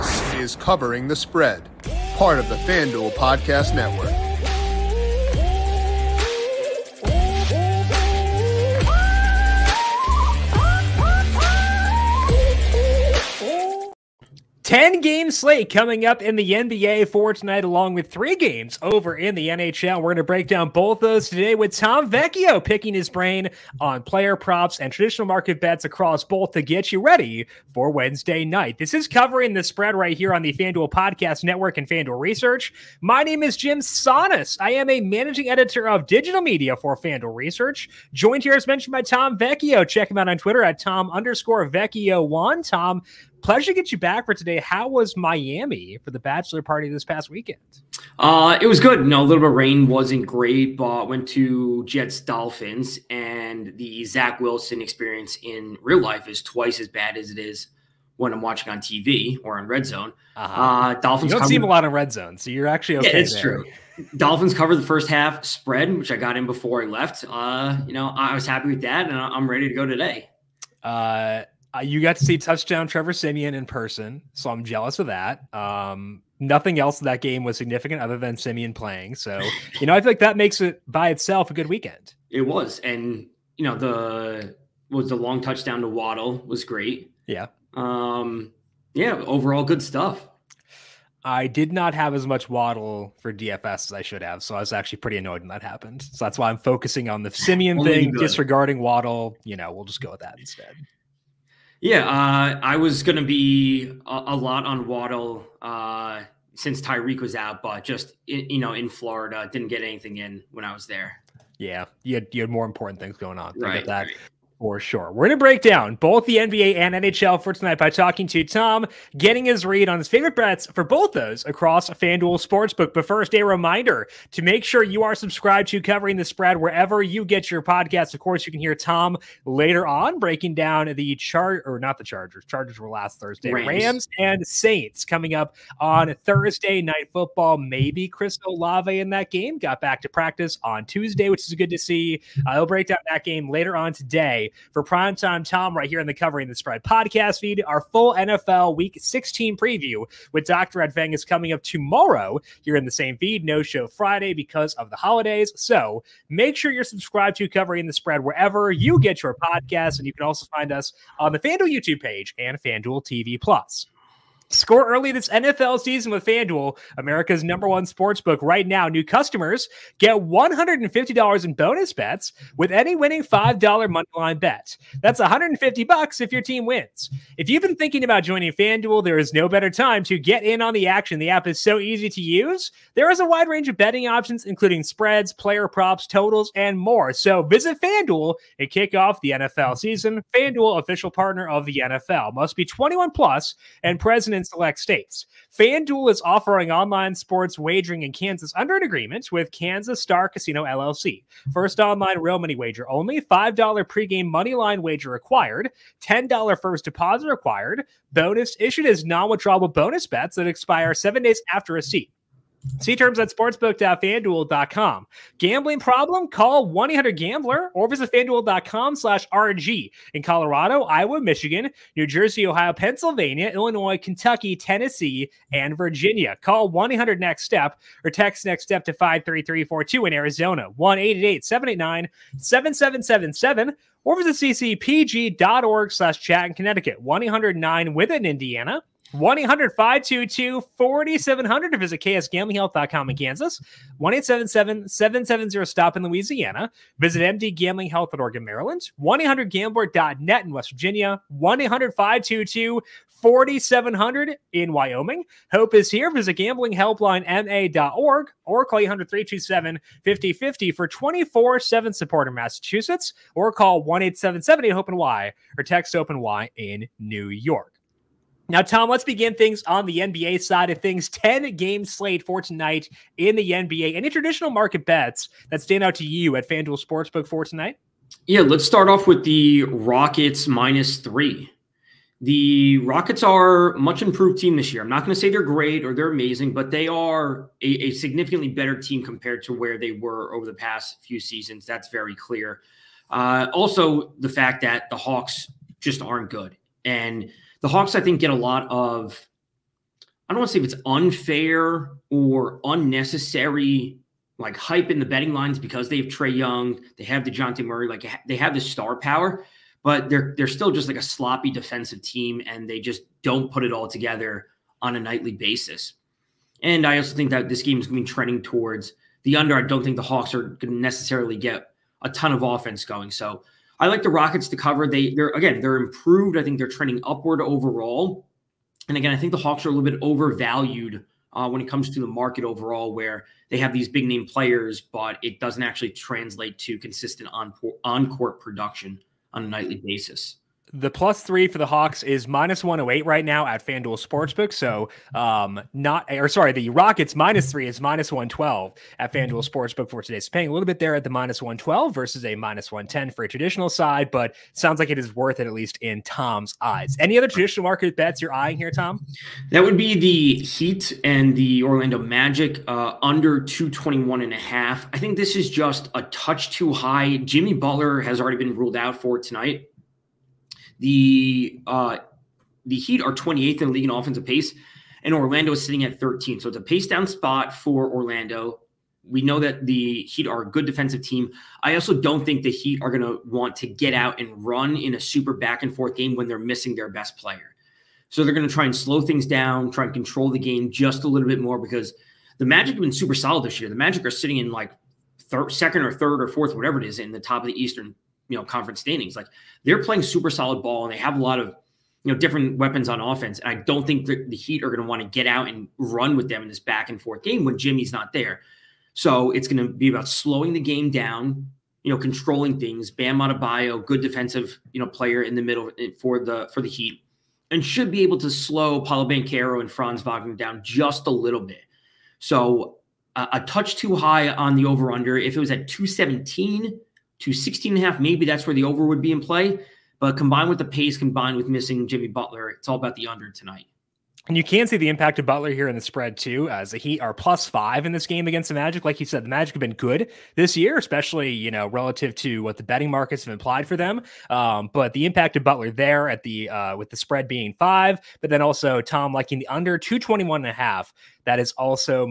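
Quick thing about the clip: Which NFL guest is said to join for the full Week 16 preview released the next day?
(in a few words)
Dr. Ed Feng.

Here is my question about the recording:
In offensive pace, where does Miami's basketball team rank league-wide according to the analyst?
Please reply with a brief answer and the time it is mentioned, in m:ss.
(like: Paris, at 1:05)
28th, at 6:13.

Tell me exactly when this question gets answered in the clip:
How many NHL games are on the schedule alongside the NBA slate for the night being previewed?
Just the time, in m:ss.
0:18.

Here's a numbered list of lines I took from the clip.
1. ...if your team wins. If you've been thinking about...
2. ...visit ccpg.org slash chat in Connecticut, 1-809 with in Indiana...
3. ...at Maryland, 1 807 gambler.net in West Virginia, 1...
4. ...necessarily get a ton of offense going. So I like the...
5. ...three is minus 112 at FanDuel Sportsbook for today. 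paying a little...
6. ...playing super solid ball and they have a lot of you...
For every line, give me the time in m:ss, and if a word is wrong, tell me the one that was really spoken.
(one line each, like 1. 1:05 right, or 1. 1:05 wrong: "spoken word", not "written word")
1. 2:56 right
2. 3:54 right
3. 4:08 wrong: "800", not "807"
4. 5:20 right
5. 5:47 right
6. 6:39 right.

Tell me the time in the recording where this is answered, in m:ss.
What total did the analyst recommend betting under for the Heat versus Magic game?
6:03.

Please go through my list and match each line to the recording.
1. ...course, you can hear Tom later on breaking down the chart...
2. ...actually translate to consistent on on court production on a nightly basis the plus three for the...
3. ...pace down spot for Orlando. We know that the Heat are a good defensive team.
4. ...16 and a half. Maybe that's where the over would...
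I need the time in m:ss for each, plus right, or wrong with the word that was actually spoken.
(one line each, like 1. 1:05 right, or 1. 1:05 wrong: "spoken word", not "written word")
1. 2:08 right
2. 5:35 right
3. 6:16 right
4. 7:07 right.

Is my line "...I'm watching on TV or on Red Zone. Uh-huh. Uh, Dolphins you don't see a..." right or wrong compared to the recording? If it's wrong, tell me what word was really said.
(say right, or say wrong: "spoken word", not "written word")
right.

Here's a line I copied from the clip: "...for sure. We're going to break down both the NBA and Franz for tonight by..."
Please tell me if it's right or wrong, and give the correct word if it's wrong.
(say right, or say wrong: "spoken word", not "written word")
wrong: "NHL", not "Franz".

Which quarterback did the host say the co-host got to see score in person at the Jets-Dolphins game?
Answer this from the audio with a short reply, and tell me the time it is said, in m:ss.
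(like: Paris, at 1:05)
Trevor Siemian, at 1:12.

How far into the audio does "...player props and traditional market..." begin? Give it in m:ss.
0:24.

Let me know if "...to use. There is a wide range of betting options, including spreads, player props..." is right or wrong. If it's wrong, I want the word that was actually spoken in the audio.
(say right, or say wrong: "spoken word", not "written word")
right.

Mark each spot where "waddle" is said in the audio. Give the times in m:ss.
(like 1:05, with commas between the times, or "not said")
1:25, 1:32, 1:38, 1:44.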